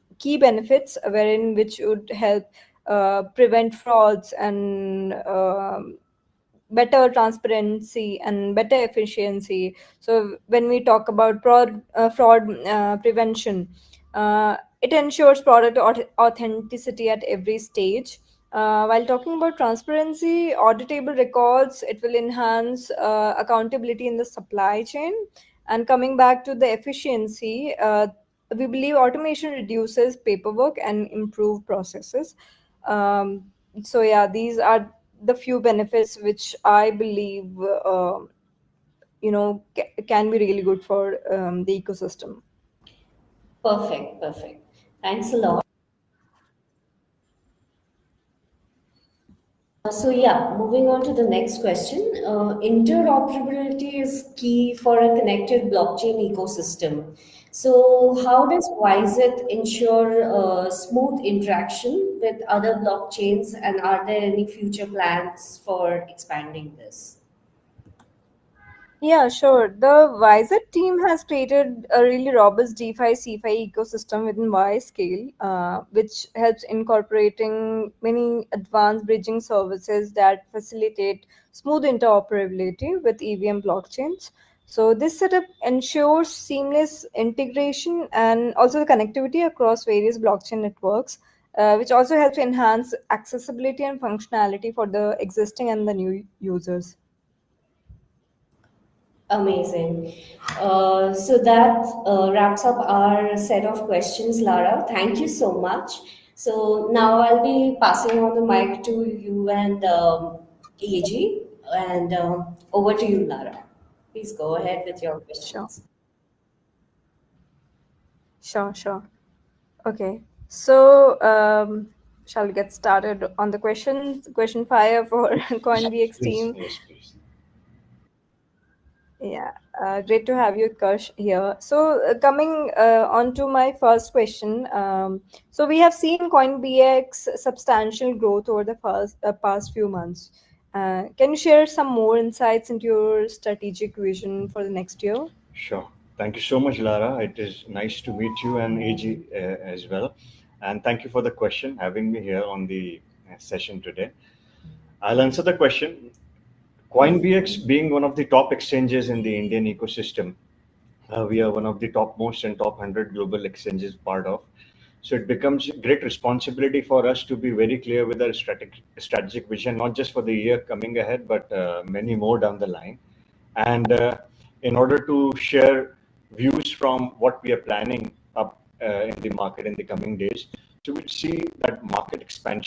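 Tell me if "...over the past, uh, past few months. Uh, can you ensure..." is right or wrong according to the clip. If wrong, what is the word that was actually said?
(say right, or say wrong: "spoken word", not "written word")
wrong: "share", not "ensure".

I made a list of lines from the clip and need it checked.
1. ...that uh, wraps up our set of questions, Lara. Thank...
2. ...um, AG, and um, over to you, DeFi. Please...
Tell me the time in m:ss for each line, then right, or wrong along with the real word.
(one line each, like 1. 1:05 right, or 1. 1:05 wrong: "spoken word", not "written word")
1. 1:41 right
2. 1:49 wrong: "Lara", not "DeFi".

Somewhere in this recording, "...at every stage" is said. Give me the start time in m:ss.
0:17.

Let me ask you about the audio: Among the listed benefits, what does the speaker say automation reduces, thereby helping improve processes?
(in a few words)
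Paperwork.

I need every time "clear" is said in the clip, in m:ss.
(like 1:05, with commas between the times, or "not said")
2:47.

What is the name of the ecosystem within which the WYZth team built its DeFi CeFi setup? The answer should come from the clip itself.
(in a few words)
WYScale.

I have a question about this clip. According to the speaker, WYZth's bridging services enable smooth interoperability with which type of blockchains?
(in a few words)
EVM blockchains.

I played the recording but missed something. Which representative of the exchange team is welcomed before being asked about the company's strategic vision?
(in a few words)
Kush.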